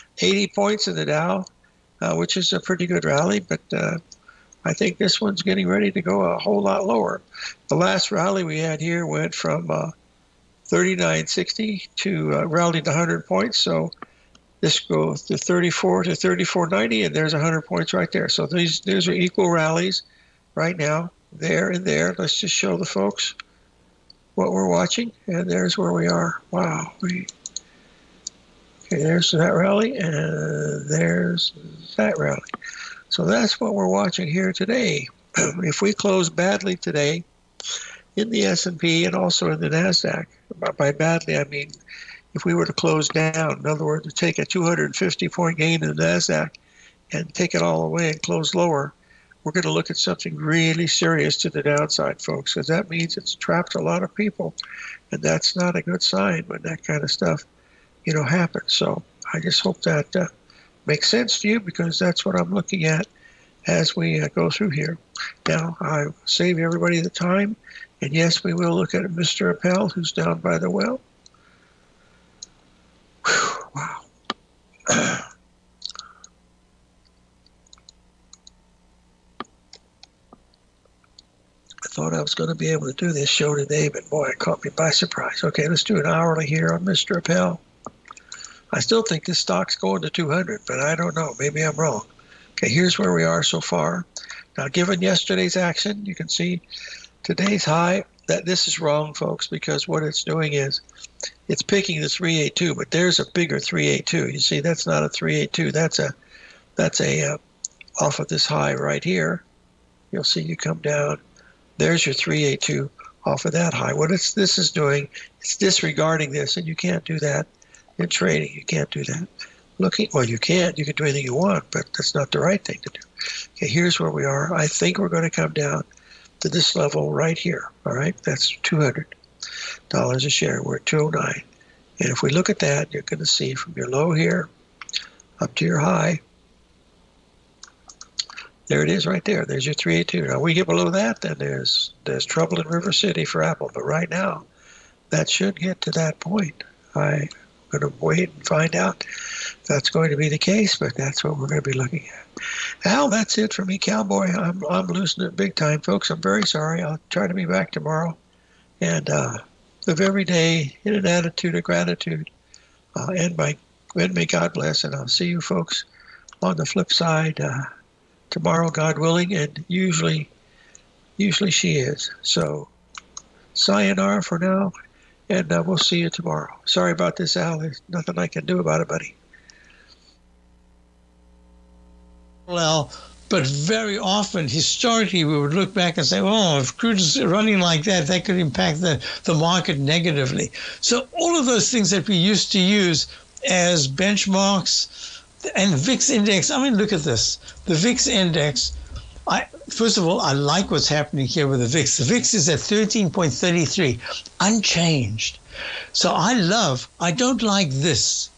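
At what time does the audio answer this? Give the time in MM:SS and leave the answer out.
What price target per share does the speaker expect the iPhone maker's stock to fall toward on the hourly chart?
02:08.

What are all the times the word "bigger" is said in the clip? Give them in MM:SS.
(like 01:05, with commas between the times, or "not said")
01:43.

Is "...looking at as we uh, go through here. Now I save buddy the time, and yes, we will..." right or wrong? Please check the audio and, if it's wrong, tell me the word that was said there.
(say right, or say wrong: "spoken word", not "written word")
wrong: "everybody", not "buddy".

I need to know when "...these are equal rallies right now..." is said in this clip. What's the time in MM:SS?
00:18.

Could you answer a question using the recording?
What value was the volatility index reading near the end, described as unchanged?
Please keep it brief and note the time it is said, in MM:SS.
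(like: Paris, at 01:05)
13.33, at 03:22.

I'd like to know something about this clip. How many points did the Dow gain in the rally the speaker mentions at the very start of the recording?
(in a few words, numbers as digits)
80.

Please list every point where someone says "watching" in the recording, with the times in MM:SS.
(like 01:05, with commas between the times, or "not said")
00:24, 00:33.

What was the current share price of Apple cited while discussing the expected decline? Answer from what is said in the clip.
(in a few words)
209.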